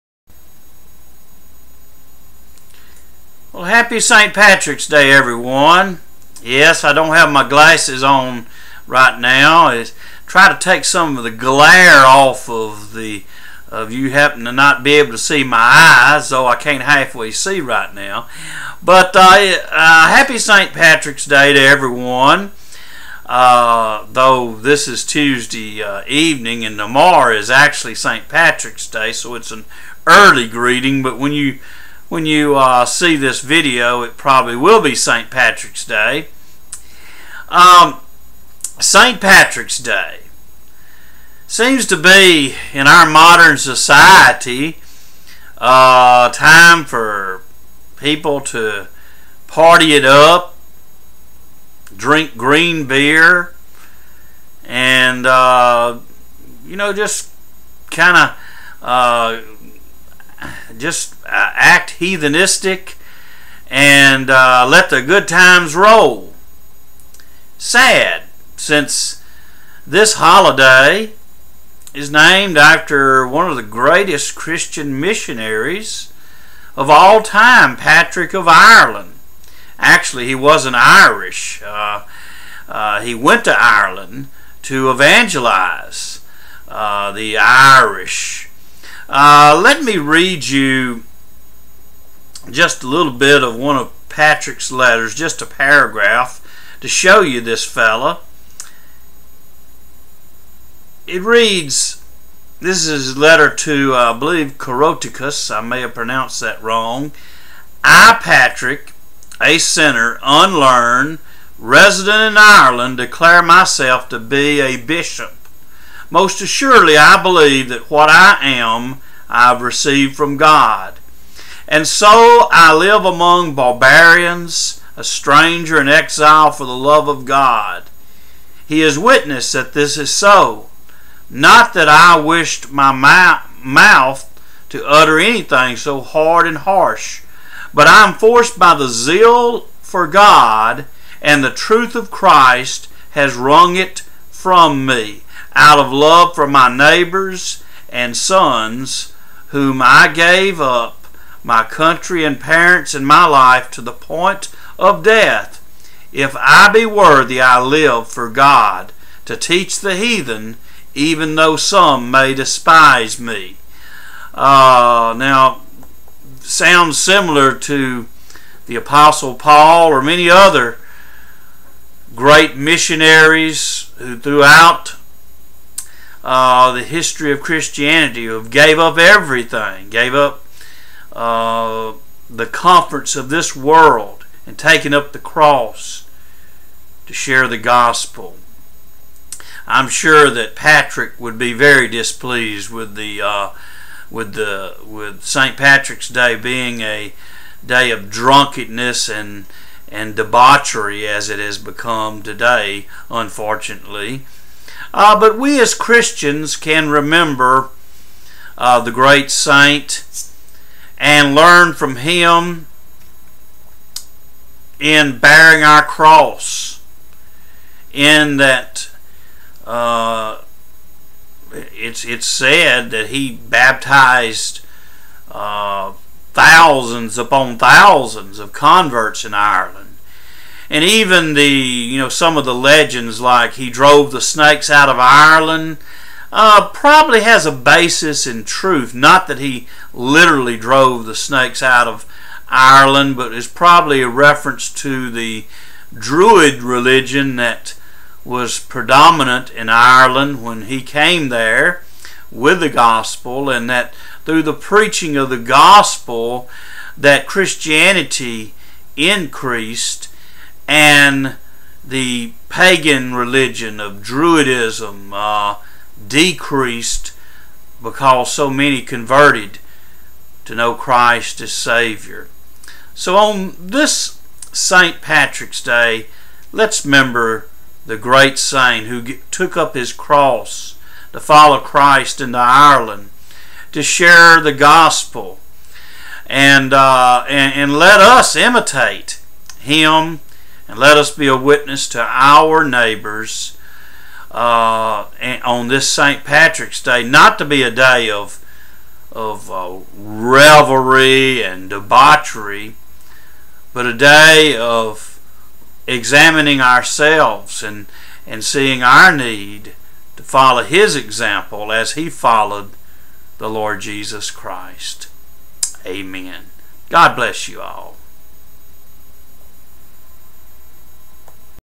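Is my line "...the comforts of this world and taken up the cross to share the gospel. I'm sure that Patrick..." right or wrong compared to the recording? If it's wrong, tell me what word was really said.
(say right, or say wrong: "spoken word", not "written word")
right.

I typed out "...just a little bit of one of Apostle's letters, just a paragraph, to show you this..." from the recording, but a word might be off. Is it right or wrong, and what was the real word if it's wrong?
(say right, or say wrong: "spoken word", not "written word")
wrong: "Patrick", not "Apostle".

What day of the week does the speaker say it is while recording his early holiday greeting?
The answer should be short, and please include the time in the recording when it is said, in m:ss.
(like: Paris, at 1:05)
Tuesday, at 0:25.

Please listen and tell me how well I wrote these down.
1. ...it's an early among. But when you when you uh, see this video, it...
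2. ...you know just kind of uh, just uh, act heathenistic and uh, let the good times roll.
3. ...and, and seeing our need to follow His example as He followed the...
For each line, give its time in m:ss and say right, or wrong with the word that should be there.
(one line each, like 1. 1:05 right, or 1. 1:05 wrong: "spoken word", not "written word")
1. 0:29 wrong: "greeting", not "among"
2. 0:56 right
3. 5:07 right.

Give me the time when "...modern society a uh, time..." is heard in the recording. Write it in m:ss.
0:43.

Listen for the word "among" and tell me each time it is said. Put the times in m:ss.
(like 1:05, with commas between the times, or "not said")
2:03.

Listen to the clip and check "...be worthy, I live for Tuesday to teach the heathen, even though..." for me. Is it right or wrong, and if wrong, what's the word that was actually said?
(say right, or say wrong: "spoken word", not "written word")
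wrong: "God", not "Tuesday".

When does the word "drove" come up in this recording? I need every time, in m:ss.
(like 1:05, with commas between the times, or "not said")
3:53, 4:00.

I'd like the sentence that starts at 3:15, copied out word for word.
Patrick's Day being a day of drunkenness and and debauchery as it has become today, unfortunately.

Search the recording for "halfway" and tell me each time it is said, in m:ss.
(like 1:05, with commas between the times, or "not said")
0:16.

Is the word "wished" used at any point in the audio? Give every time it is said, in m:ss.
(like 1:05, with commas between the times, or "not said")
2:12.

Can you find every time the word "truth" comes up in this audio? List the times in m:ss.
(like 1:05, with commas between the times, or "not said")
2:21, 3:58.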